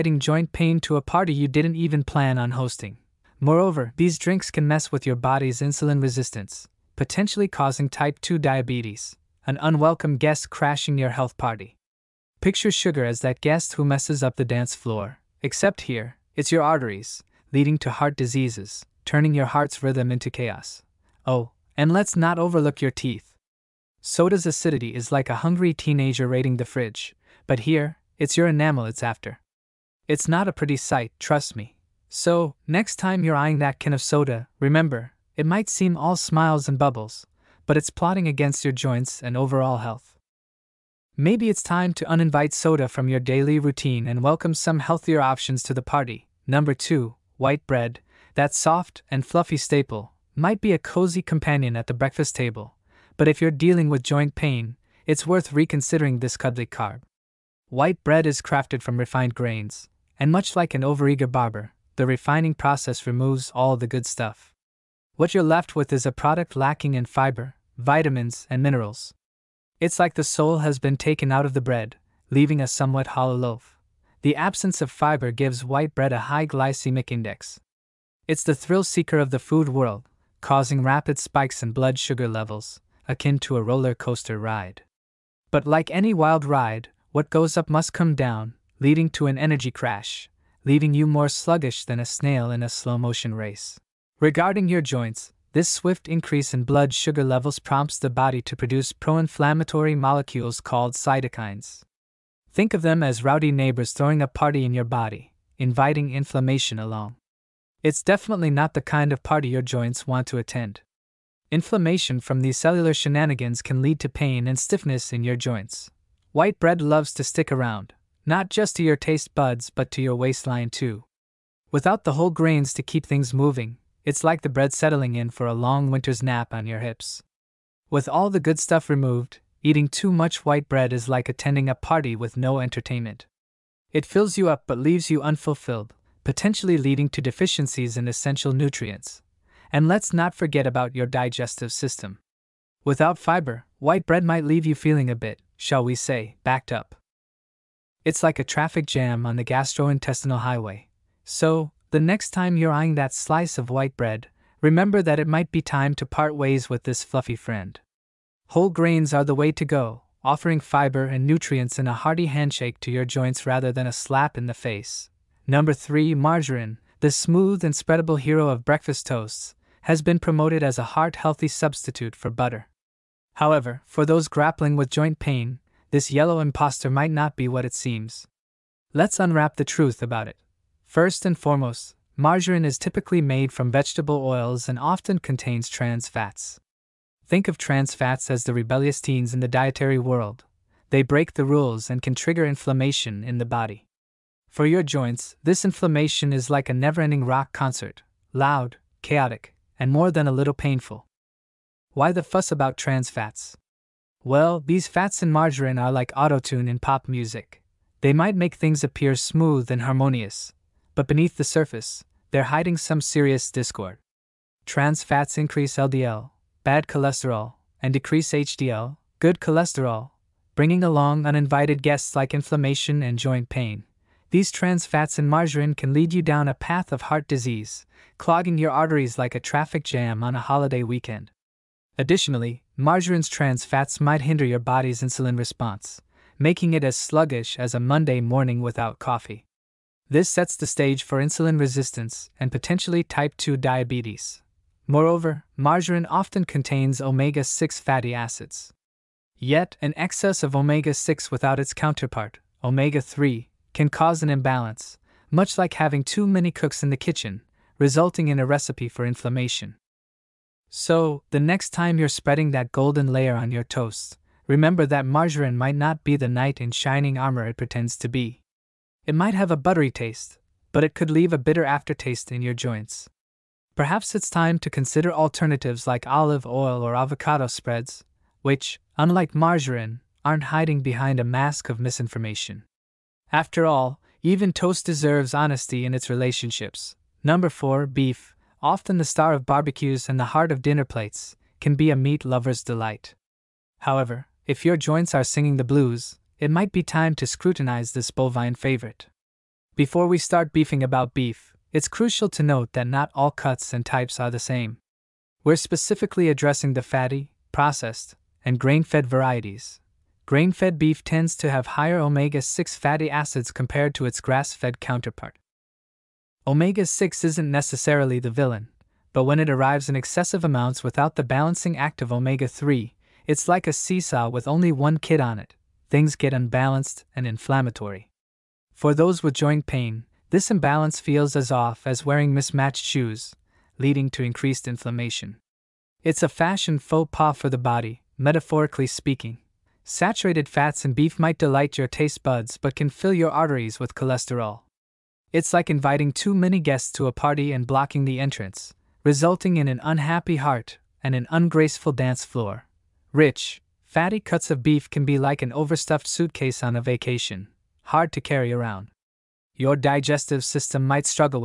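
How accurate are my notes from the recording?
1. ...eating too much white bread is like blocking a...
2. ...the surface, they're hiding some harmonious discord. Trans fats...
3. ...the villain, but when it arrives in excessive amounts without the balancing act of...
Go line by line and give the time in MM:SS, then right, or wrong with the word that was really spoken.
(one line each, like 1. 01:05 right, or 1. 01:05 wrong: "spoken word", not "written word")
1. 02:09 wrong: "attending", not "blocking"
2. 03:31 wrong: "serious", not "harmonious"
3. 05:18 right.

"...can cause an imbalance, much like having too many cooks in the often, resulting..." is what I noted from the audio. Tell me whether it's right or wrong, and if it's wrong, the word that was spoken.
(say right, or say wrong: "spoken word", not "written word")
wrong: "kitchen", not "often".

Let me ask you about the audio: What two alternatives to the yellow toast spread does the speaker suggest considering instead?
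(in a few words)
olive oil or avocado spreads.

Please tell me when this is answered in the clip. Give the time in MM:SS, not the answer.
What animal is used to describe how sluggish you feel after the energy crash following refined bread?
01:32.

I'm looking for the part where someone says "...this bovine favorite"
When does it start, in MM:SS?
04:57.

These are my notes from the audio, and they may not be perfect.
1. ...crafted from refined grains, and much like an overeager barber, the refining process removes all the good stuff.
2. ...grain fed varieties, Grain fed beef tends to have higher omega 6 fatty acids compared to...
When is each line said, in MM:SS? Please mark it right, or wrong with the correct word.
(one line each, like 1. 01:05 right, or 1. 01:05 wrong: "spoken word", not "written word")
1. 00:58 right
2. 05:08 right.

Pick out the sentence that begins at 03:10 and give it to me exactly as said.
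They break the rules and can trigger inflammation in the body.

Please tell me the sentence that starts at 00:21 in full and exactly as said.
Oh, and let's not overlook your teeth.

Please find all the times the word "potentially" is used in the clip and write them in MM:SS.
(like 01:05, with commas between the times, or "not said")
00:06, 02:16, 04:02.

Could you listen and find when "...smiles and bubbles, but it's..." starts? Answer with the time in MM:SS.
00:36.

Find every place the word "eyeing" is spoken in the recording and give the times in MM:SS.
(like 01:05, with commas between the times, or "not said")
00:33, 02:32.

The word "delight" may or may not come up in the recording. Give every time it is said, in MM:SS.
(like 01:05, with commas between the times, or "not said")
04:52, 05:41.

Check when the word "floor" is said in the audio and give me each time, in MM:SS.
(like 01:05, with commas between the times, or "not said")
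00:14, 05:52.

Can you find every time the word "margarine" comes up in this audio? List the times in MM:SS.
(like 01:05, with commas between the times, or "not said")
02:46, 03:02, 03:25, 03:45, 03:52, 04:05, 04:25, 04:39.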